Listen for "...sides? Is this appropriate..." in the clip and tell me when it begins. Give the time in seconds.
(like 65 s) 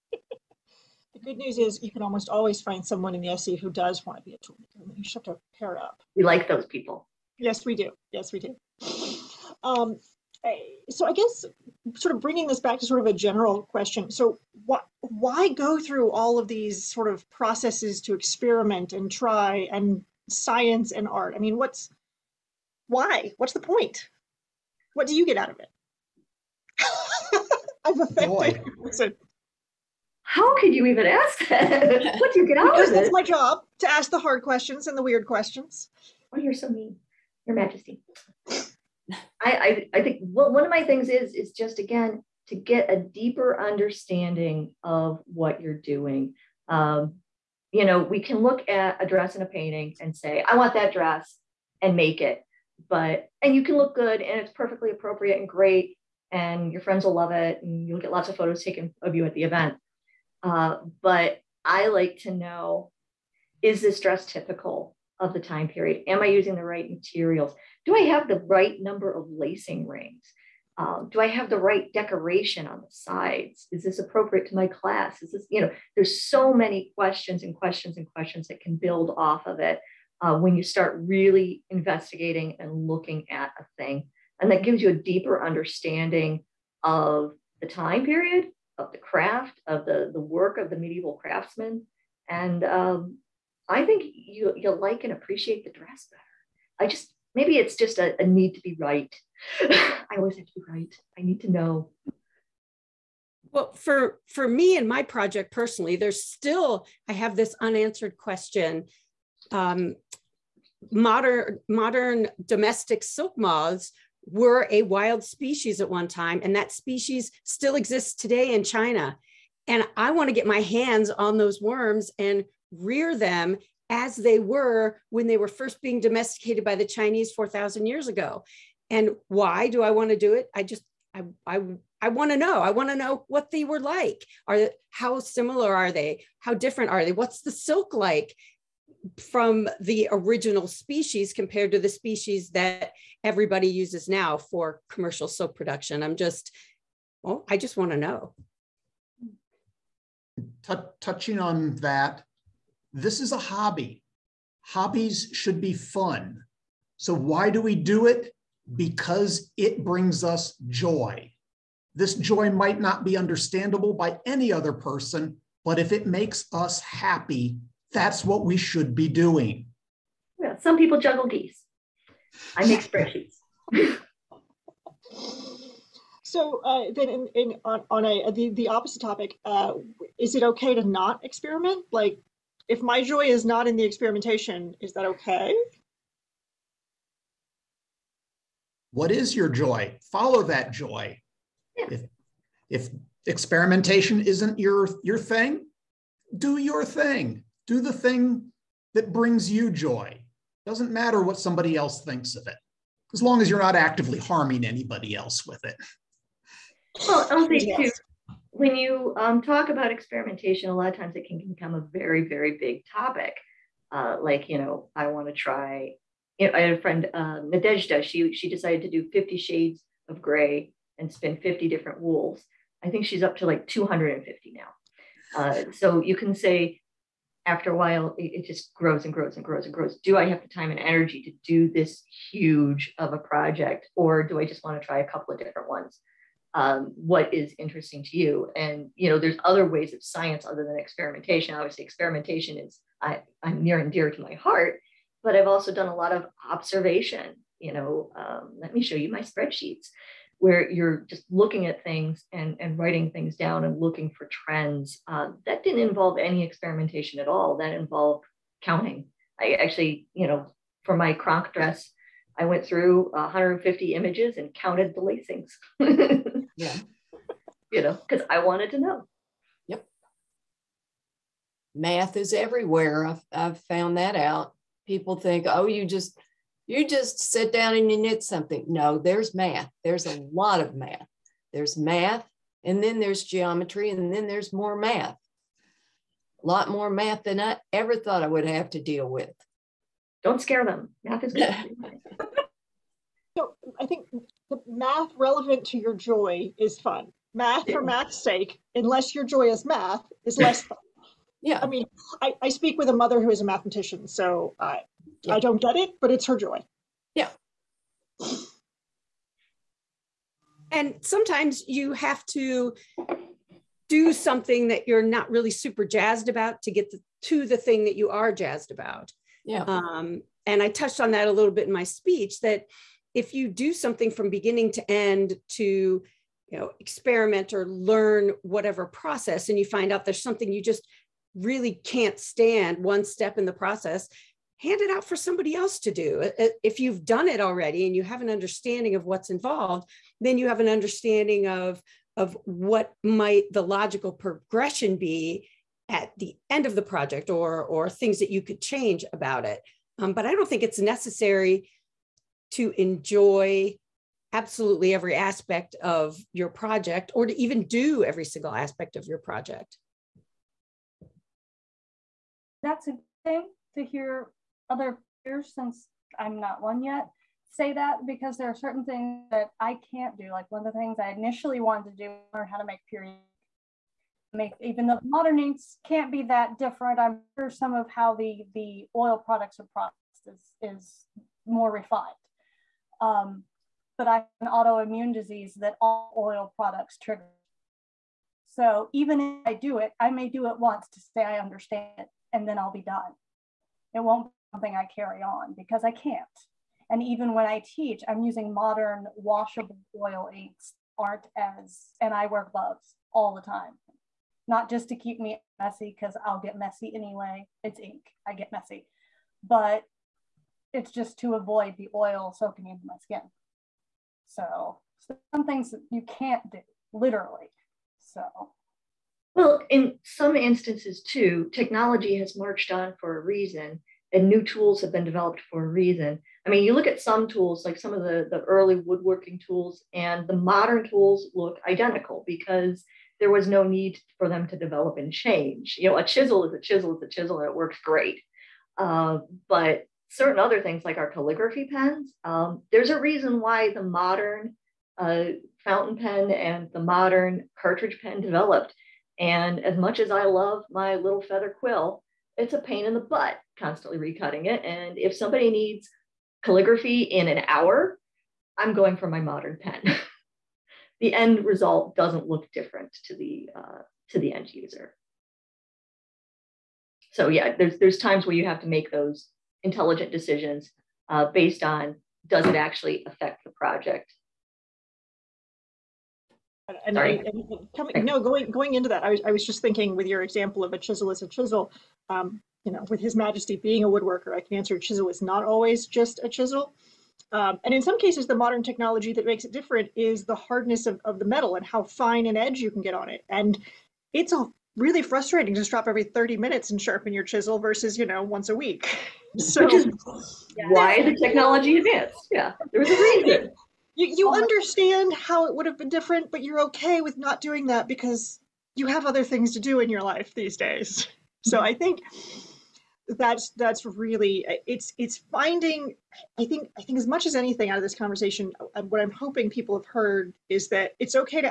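72 s.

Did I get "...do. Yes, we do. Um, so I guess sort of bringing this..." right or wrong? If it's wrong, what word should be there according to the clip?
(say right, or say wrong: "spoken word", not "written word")
right.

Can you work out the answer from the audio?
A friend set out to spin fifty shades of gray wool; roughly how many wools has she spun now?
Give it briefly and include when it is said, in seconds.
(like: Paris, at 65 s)
250, at 223 s.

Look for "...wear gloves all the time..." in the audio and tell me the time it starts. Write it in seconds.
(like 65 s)
402 s.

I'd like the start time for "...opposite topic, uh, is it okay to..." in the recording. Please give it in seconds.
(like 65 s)
178 s.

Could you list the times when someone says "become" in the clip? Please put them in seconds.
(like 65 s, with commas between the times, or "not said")
211 s.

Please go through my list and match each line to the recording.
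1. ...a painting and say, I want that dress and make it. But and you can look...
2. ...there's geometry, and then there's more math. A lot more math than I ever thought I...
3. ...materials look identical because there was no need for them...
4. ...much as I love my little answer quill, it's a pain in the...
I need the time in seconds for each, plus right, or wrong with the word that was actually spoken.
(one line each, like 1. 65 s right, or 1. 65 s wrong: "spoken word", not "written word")
1. 49 s right
2. 282 s right
3. 430 s wrong: "tools", not "materials"
4. 449 s wrong: "feather", not "answer".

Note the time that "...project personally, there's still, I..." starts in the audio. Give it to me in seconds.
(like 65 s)
105 s.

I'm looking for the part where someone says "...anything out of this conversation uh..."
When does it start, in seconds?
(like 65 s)
517 s.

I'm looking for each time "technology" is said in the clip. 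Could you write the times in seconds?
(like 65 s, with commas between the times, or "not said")
421 s, 488 s, 501 s.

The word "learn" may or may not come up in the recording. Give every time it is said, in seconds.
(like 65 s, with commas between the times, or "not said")
327 s, 372 s.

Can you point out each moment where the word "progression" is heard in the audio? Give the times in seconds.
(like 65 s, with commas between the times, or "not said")
344 s.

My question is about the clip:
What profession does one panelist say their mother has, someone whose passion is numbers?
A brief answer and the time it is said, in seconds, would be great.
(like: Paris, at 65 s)
mathematician, at 303 s.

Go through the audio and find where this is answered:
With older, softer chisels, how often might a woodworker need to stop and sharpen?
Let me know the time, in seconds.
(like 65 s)
495 s.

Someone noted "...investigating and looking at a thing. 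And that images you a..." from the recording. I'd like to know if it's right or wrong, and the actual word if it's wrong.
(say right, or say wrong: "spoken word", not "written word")
wrong: "gives", not "images".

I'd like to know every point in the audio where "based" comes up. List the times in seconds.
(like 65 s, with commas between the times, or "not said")
471 s.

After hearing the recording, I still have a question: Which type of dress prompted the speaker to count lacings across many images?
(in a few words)
Cranach dress.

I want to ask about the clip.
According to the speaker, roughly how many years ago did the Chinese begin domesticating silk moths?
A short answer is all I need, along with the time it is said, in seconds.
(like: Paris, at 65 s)
4,000, at 127 s.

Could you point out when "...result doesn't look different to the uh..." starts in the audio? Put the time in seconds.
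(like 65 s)
461 s.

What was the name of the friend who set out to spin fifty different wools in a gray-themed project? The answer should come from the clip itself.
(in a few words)
Nadezhda.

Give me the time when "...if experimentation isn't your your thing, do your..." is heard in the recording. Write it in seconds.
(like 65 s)
192 s.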